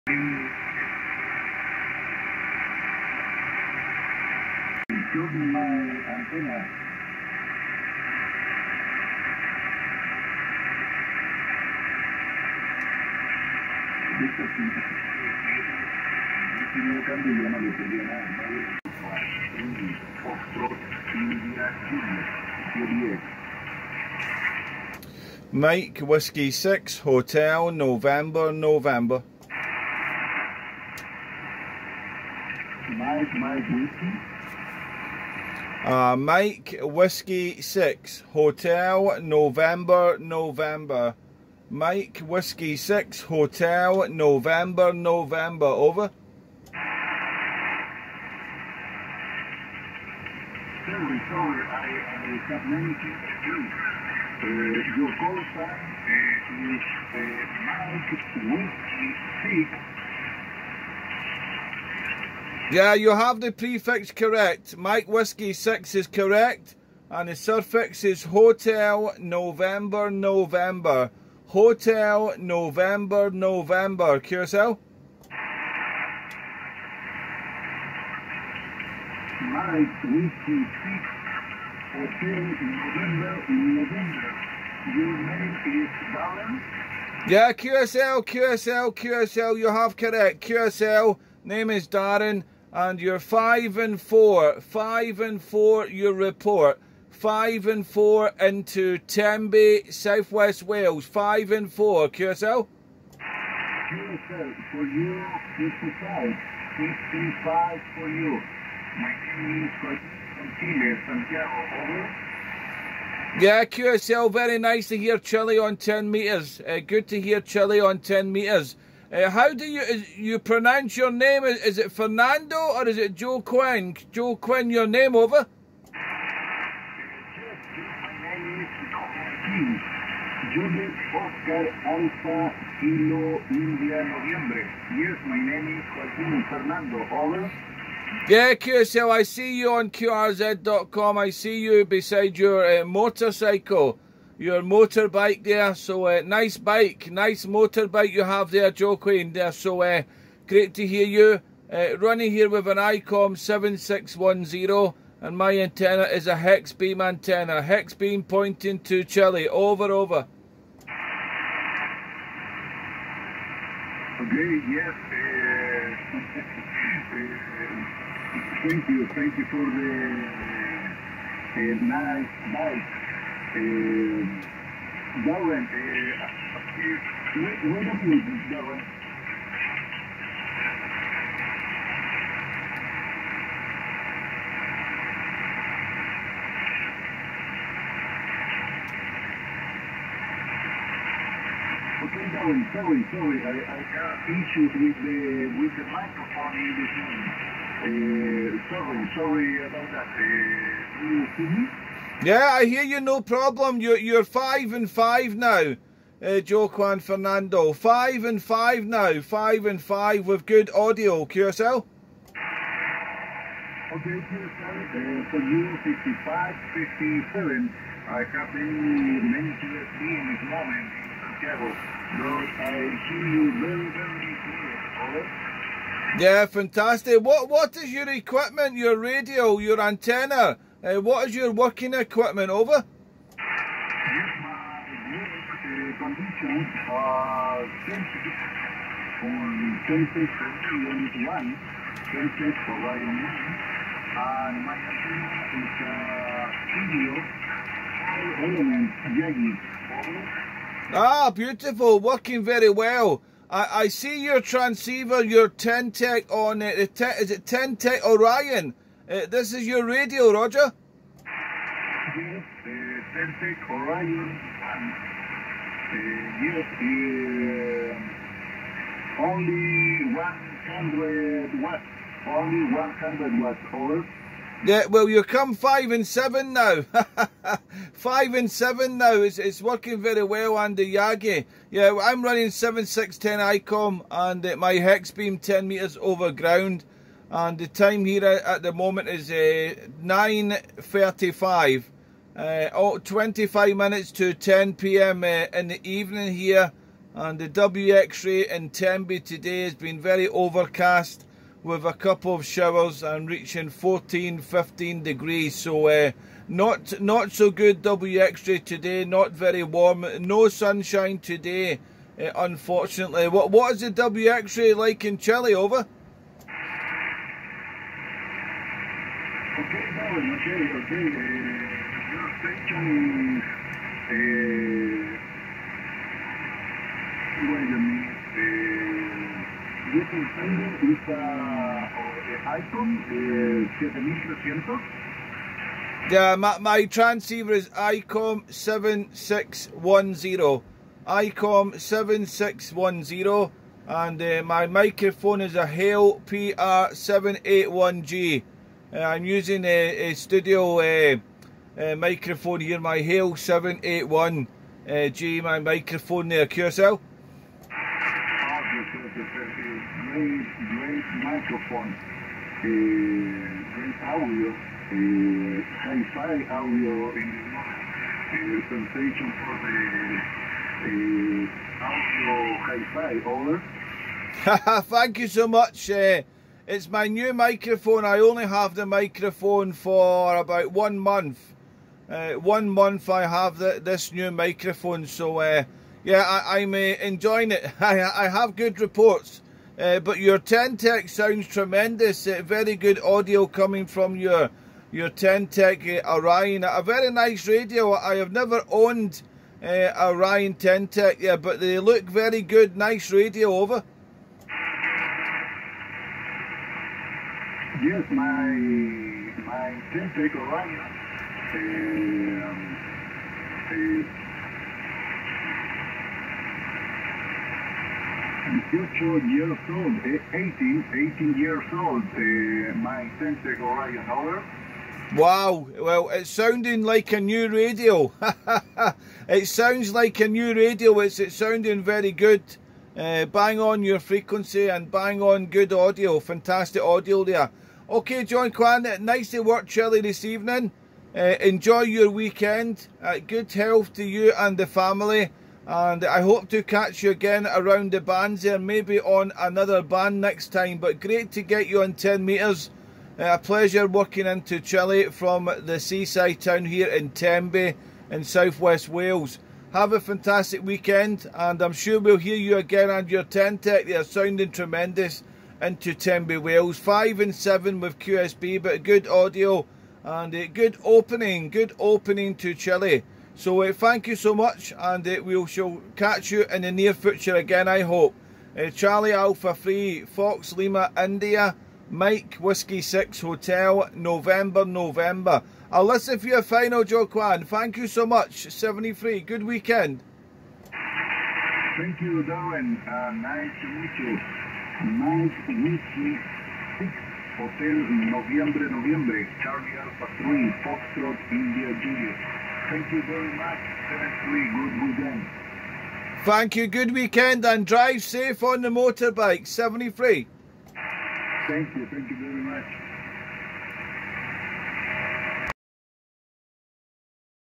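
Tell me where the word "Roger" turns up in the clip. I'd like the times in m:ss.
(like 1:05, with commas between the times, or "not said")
4:20.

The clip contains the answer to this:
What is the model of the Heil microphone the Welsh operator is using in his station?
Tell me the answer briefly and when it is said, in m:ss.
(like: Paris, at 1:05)
PR781G, at 5:45.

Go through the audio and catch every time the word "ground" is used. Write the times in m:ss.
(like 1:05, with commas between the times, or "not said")
4:46.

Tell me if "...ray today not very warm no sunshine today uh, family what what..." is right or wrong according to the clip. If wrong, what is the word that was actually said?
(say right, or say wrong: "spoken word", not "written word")
wrong: "unfortunately", not "family".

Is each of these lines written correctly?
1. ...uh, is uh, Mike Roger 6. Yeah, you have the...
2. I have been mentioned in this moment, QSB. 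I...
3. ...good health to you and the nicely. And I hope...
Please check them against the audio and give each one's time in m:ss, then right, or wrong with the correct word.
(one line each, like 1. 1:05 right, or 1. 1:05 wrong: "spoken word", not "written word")
1. 0:56 wrong: "Whiskey", not "Roger"
2. 3:38 wrong: "Santiago", not "QSB"
3. 7:23 wrong: "family", not "nicely".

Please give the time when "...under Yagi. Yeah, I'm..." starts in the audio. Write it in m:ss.
4:40.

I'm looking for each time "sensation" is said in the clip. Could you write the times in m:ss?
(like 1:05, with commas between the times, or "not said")
6:08.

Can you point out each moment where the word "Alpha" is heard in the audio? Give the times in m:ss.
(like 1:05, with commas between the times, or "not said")
7:59, 8:19.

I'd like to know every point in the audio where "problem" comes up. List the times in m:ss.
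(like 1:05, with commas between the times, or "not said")
3:23.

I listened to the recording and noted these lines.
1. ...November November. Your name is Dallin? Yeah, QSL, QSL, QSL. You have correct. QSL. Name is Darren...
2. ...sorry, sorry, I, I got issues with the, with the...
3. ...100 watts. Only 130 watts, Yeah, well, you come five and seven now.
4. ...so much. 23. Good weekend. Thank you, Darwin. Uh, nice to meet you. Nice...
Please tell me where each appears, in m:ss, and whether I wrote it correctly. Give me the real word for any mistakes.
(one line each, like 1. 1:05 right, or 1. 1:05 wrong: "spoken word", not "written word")
1. 1:22 right
2. 3:12 right
3. 4:30 wrong: "100", not "130"
4. 8:07 wrong: "73", not "23".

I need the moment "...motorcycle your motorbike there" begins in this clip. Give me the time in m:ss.
2:22.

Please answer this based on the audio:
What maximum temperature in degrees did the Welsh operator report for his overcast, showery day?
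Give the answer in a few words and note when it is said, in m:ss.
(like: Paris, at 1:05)
15 degrees, at 5:03.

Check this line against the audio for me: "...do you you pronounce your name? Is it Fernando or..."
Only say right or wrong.
right.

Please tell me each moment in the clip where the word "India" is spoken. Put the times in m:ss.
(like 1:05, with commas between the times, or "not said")
8:01, 8:21.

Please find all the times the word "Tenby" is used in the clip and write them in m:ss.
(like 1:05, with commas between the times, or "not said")
1:38, 4:58, 7:37, 7:45.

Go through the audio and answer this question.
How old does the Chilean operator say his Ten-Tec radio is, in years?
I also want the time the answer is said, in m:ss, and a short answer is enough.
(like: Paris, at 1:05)
18, at 7:01.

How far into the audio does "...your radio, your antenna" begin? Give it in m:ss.
3:48.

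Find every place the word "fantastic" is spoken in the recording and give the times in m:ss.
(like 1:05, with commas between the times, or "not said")
3:46, 7:16, 7:40.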